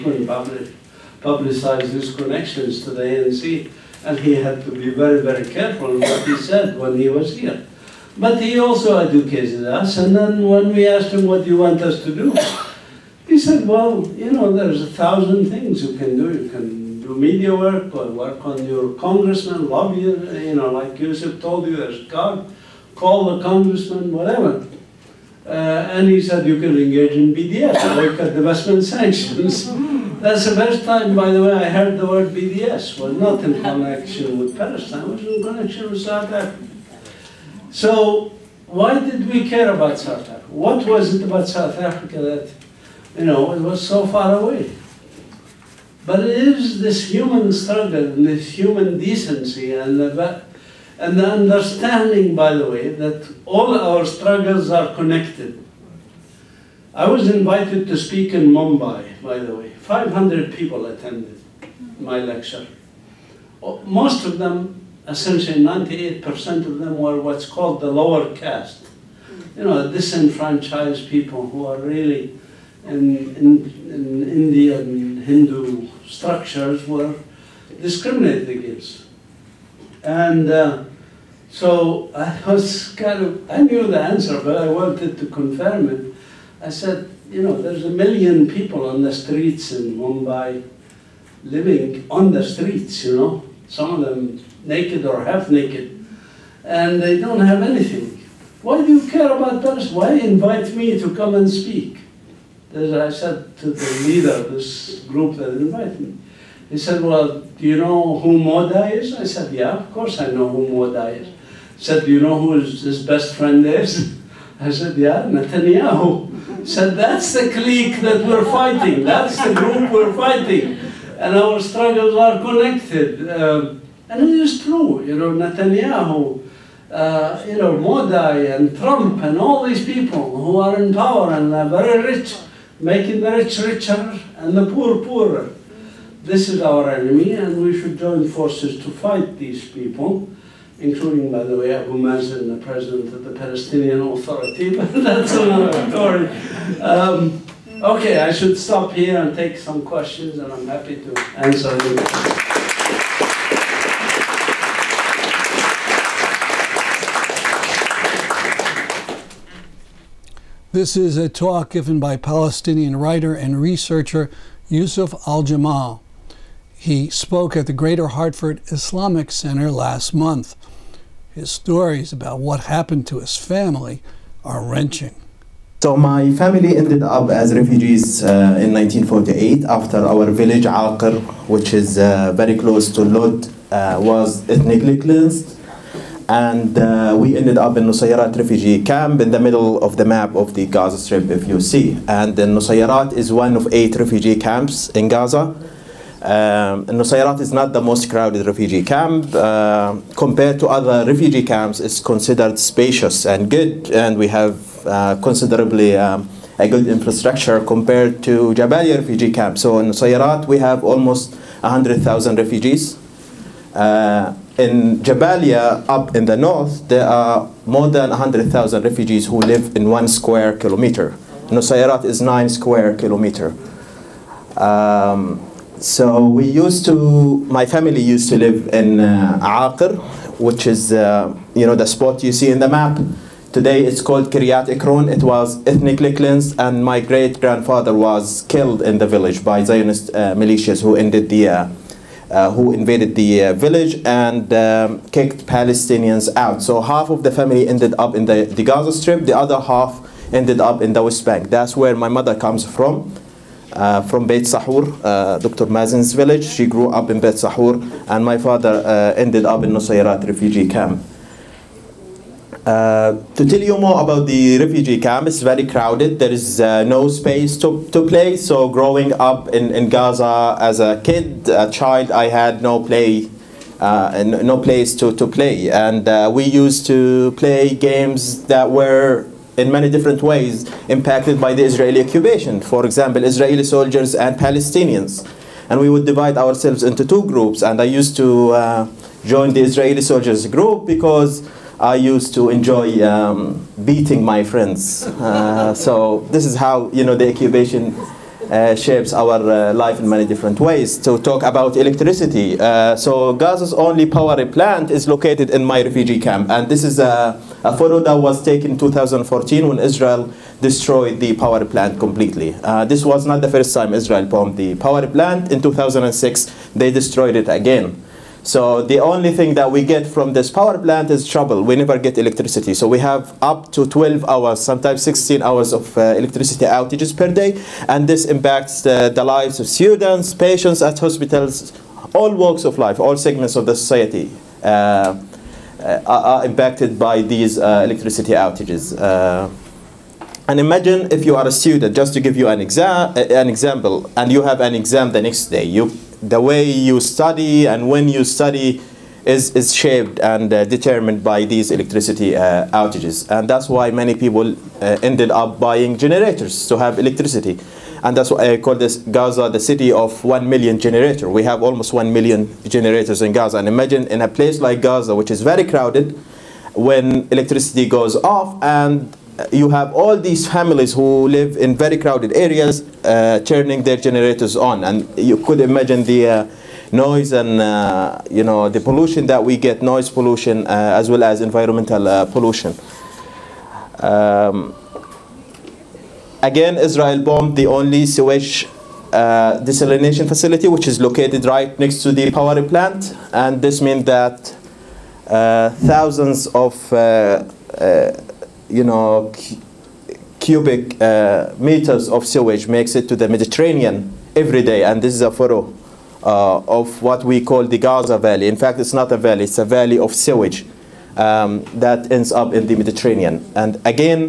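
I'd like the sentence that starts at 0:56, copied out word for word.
I was invited to speak in Mumbai, by the way.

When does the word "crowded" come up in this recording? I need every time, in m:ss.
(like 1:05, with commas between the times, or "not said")
3:18, 4:25, 6:05, 6:11.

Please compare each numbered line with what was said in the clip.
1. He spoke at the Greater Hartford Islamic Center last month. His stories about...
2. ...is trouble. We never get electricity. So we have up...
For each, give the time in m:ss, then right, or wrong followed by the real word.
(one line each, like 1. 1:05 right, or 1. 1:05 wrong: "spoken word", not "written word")
1. 2:46 right
2. 5:21 right.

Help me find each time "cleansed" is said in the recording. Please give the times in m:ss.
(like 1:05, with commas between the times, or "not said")
3:04, 3:56.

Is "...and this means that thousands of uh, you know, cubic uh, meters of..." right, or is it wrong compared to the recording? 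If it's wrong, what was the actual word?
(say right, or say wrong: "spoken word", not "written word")
right.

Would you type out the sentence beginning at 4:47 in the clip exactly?
And I used to uh, join the Israeli soldiers group because I used to enjoy um, beating my friends.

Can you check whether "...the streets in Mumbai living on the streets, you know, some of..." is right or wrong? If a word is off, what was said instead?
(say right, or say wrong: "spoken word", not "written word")
right.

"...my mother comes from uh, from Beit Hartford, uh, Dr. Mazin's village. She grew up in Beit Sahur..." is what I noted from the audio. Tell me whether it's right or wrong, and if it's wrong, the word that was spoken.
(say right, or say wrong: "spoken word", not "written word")
wrong: "Sahur", not "Hartford".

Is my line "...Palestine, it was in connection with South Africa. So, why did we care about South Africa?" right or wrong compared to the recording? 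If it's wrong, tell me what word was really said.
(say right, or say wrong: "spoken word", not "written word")
right.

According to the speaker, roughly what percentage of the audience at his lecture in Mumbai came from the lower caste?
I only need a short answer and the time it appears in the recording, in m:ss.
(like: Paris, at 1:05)
98%, at 1:05.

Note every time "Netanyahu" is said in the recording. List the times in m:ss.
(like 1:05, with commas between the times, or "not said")
1:55, 2:05.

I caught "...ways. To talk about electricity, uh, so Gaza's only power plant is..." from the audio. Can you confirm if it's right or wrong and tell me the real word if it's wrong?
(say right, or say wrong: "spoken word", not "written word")
right.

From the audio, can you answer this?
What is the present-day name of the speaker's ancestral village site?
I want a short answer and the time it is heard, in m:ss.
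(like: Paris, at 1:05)
Kiryat Ekron, at 3:54.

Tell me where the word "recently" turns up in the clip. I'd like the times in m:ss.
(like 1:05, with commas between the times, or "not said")
not said.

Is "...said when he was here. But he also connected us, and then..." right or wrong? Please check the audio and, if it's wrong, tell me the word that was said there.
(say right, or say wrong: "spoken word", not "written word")
wrong: "educated", not "connected".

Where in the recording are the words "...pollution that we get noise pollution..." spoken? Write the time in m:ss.
6:18.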